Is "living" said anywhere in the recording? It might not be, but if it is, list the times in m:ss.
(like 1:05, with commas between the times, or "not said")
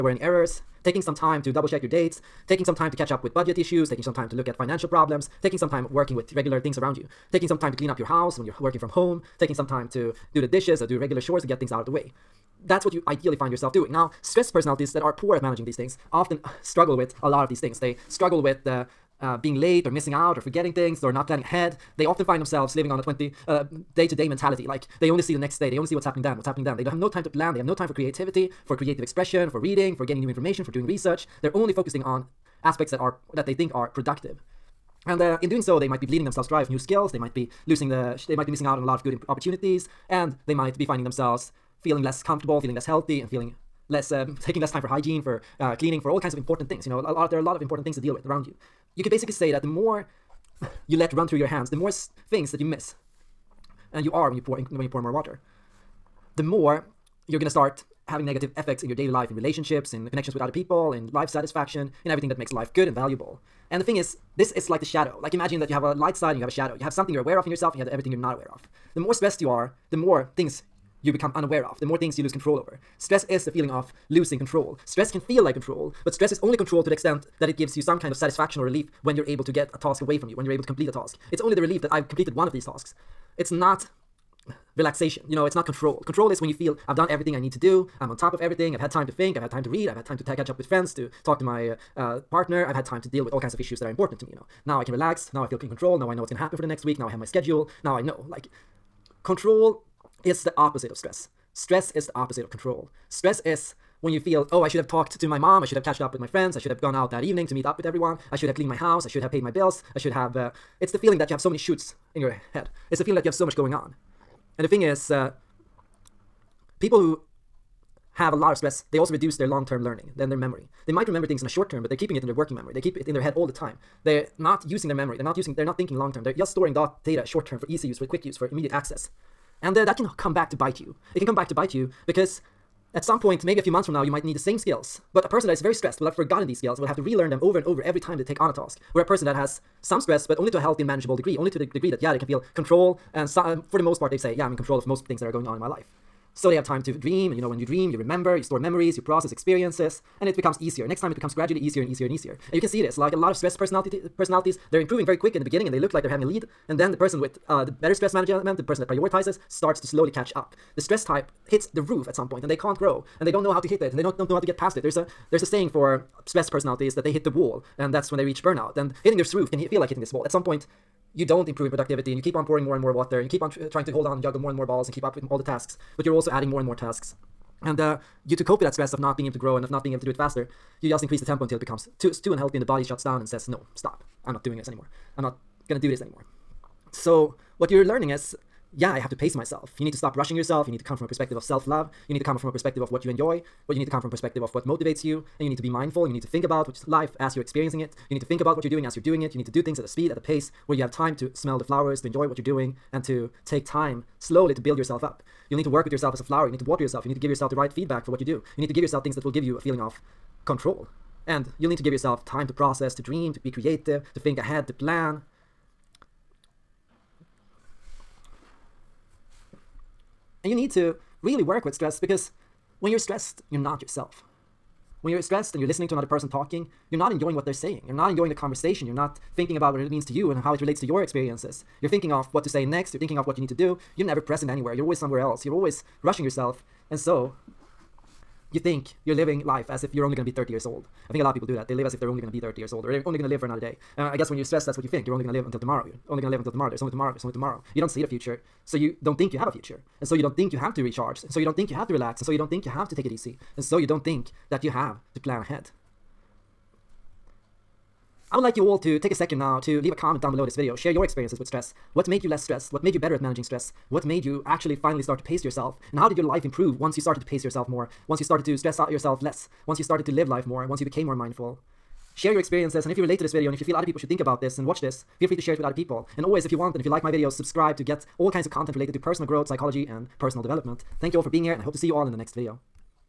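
0:22, 3:59.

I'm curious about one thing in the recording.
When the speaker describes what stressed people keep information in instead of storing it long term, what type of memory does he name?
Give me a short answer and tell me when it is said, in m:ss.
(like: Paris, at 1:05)
working memory, at 2:02.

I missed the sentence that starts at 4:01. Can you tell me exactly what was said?
I think a lot of people do that.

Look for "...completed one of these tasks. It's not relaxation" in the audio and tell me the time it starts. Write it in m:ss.
1:22.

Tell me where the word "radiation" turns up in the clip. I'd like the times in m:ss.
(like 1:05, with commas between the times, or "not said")
not said.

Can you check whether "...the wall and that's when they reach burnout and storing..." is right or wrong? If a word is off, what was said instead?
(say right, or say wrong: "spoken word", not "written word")
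wrong: "hitting", not "storing".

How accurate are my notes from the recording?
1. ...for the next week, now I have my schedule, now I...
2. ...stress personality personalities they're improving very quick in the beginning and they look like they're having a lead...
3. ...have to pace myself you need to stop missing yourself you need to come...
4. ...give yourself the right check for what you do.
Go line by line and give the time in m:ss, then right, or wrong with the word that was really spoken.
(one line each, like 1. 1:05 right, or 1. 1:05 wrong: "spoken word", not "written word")
1. 1:36 right
2. 2:33 right
3. 3:08 wrong: "rushing", not "missing"
4. 3:27 wrong: "feedback", not "check".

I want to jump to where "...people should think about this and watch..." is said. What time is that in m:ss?
4:33.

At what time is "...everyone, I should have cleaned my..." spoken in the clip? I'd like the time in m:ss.
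1:47.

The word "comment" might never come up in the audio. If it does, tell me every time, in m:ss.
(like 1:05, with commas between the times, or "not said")
4:19.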